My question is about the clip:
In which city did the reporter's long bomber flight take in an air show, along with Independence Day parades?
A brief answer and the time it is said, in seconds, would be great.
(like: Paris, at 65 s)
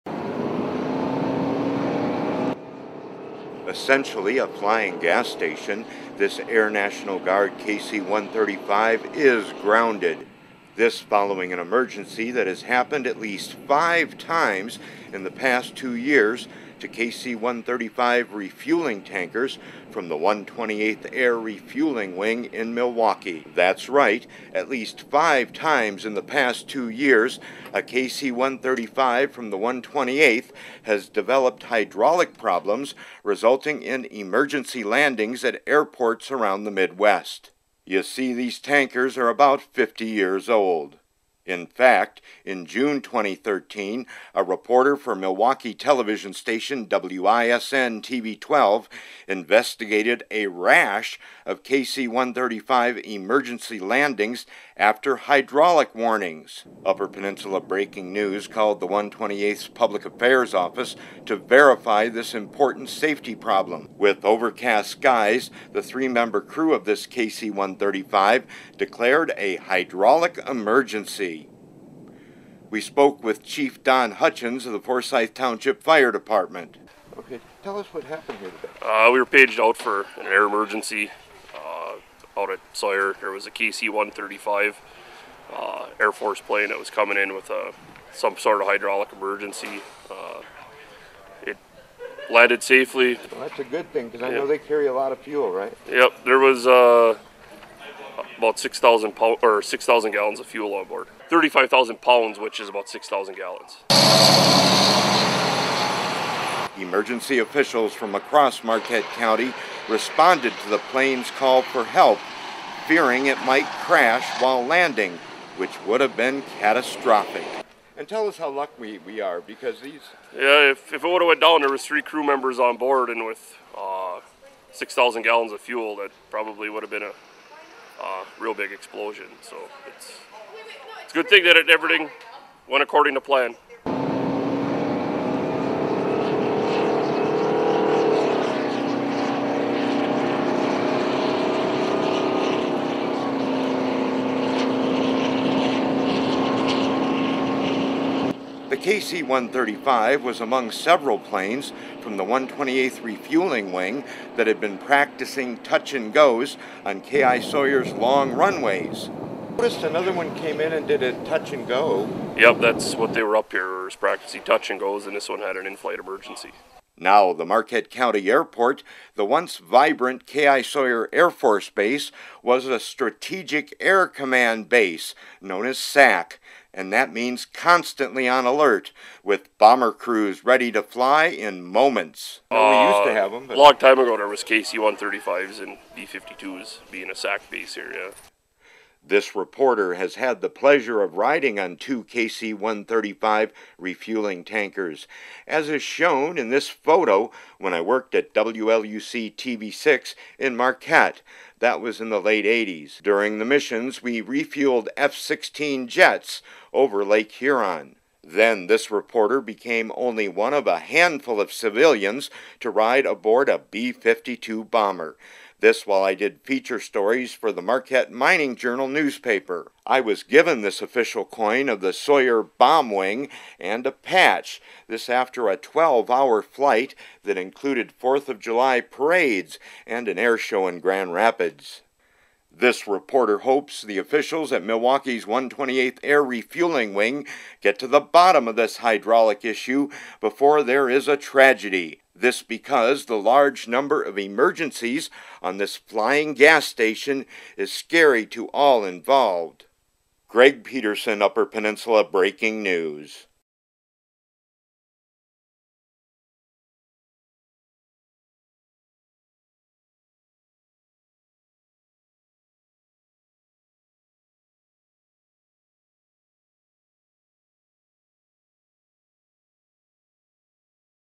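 Grand Rapids, at 230 s.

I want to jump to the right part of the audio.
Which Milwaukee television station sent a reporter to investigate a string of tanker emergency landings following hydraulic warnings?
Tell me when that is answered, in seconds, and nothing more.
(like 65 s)
46 s.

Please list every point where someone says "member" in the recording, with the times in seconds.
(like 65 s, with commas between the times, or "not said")
66 s, 122 s.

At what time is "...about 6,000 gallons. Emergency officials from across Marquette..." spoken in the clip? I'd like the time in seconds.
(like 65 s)
102 s.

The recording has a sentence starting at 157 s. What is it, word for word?
Sawyer's long runways noticed another one came in and did a touch and go.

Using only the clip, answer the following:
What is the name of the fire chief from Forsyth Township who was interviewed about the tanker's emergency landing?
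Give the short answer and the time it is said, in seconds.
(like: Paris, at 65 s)
Don Hutchins, at 73 s.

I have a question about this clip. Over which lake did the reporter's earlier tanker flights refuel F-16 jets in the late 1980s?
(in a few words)
Lake Huron.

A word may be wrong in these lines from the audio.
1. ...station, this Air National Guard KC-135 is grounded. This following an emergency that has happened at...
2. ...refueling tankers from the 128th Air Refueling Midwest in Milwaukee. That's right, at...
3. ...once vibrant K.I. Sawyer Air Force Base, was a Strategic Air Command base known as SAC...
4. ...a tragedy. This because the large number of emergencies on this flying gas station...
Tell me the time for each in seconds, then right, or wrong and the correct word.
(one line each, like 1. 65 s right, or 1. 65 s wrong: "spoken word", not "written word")
1. 5 s right
2. 18 s wrong: "Wing", not "Midwest"
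3. 169 s right
4. 241 s right.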